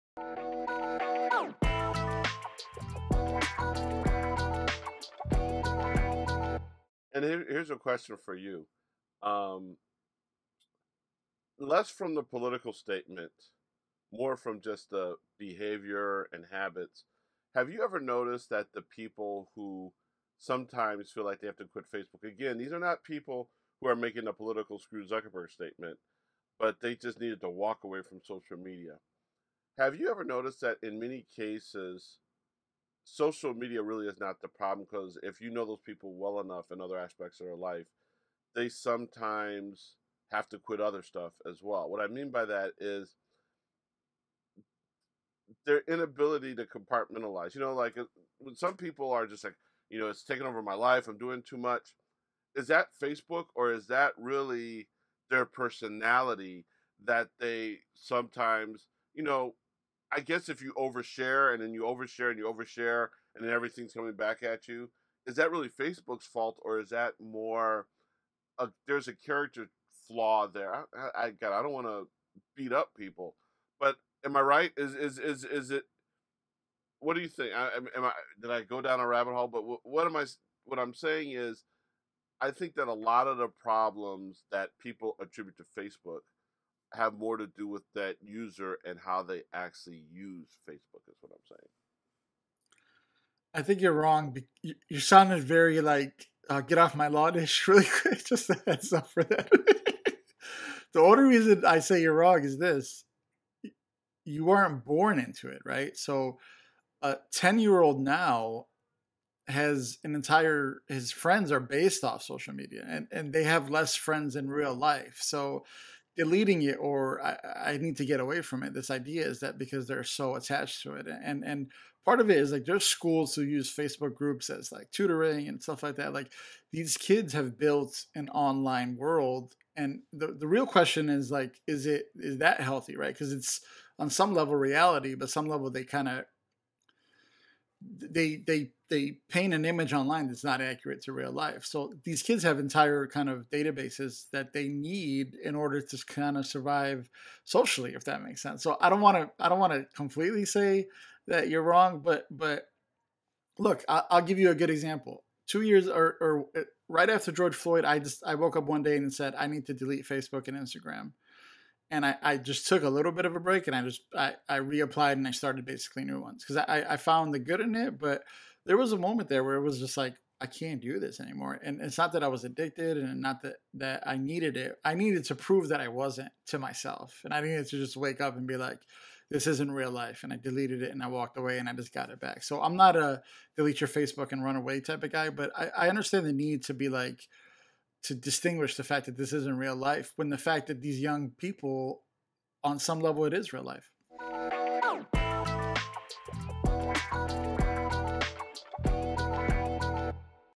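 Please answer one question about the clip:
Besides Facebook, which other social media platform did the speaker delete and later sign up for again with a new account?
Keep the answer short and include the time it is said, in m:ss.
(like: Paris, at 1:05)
Instagram, at 2:40.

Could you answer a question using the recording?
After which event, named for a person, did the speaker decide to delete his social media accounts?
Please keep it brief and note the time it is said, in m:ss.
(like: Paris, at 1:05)
George Floyd, at 2:37.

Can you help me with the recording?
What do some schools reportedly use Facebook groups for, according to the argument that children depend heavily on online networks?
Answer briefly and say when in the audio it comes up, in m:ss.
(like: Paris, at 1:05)
Tutoring, at 2:04.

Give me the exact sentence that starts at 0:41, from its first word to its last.
What I mean by that is their inability to compartmentalize.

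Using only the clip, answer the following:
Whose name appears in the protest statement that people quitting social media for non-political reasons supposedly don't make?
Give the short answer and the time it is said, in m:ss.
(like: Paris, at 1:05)
Zuckerberg, at 0:25.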